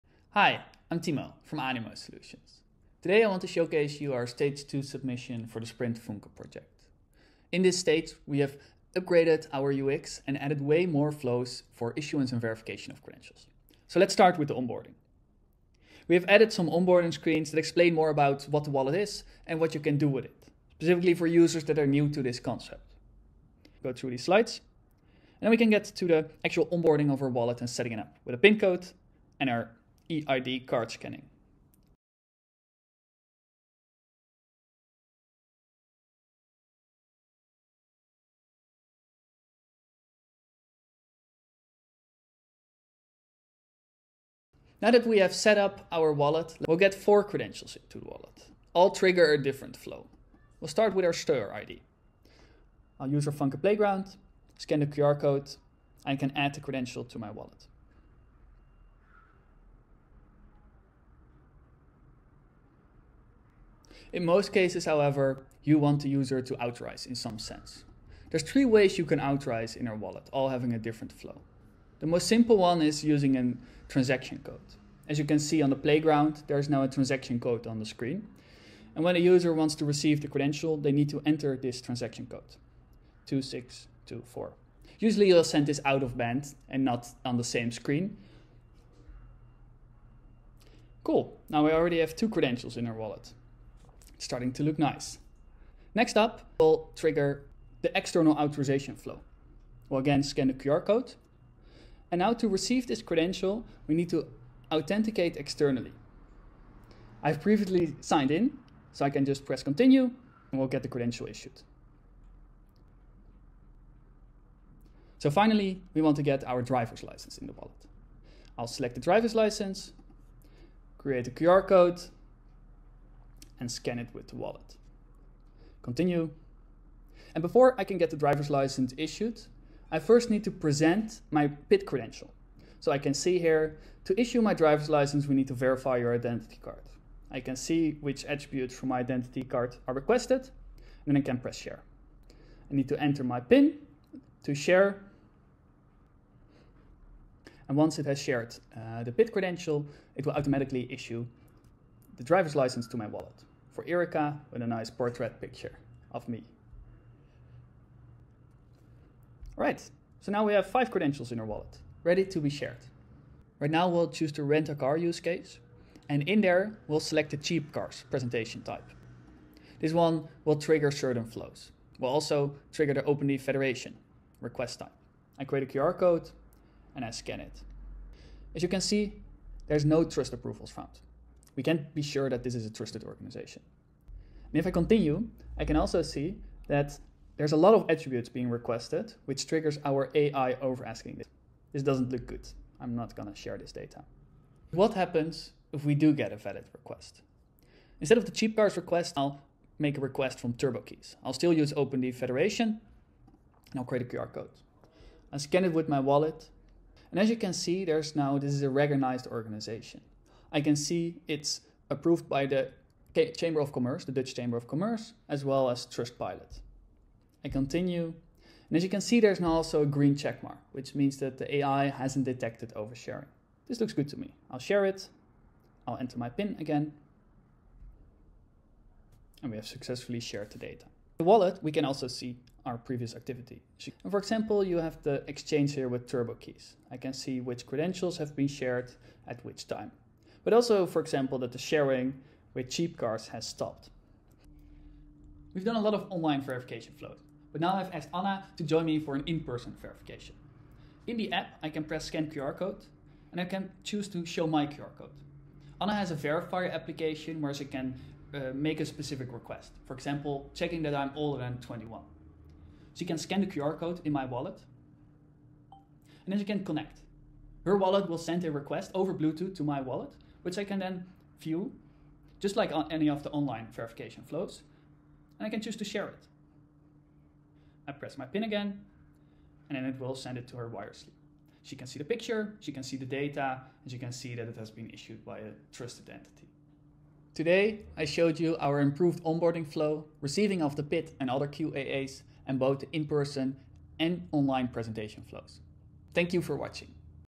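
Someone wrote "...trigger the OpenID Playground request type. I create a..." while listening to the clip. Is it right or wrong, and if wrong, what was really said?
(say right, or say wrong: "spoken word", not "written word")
wrong: "Federation", not "Playground".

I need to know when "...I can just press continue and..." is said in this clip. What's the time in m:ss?
1:49.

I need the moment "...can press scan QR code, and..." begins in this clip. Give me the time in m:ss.
4:11.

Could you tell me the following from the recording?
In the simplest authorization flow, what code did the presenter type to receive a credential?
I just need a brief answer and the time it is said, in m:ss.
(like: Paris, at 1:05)
2624, at 1:23.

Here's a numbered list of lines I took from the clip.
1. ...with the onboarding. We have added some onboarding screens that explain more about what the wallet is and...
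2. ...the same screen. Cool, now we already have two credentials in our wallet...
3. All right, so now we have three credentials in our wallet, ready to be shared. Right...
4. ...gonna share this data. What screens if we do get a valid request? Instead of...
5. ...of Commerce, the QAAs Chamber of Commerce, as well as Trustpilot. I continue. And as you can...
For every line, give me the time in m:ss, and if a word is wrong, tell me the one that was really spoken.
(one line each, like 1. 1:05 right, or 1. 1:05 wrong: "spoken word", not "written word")
1. 0:14 right
2. 1:27 right
3. 2:39 wrong: "five", not "three"
4. 3:13 wrong: "happens", not "screens"
5. 3:33 wrong: "Dutch", not "QAAs".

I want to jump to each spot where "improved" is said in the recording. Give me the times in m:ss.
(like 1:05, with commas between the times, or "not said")
4:48.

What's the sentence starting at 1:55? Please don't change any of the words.
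So finally, we want to get our driver's license in the wallet.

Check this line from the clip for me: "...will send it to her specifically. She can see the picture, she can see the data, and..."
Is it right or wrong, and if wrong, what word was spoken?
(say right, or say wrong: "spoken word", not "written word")
wrong: "wirelessly", not "specifically".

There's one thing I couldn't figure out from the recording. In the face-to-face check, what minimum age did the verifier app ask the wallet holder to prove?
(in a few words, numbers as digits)
21.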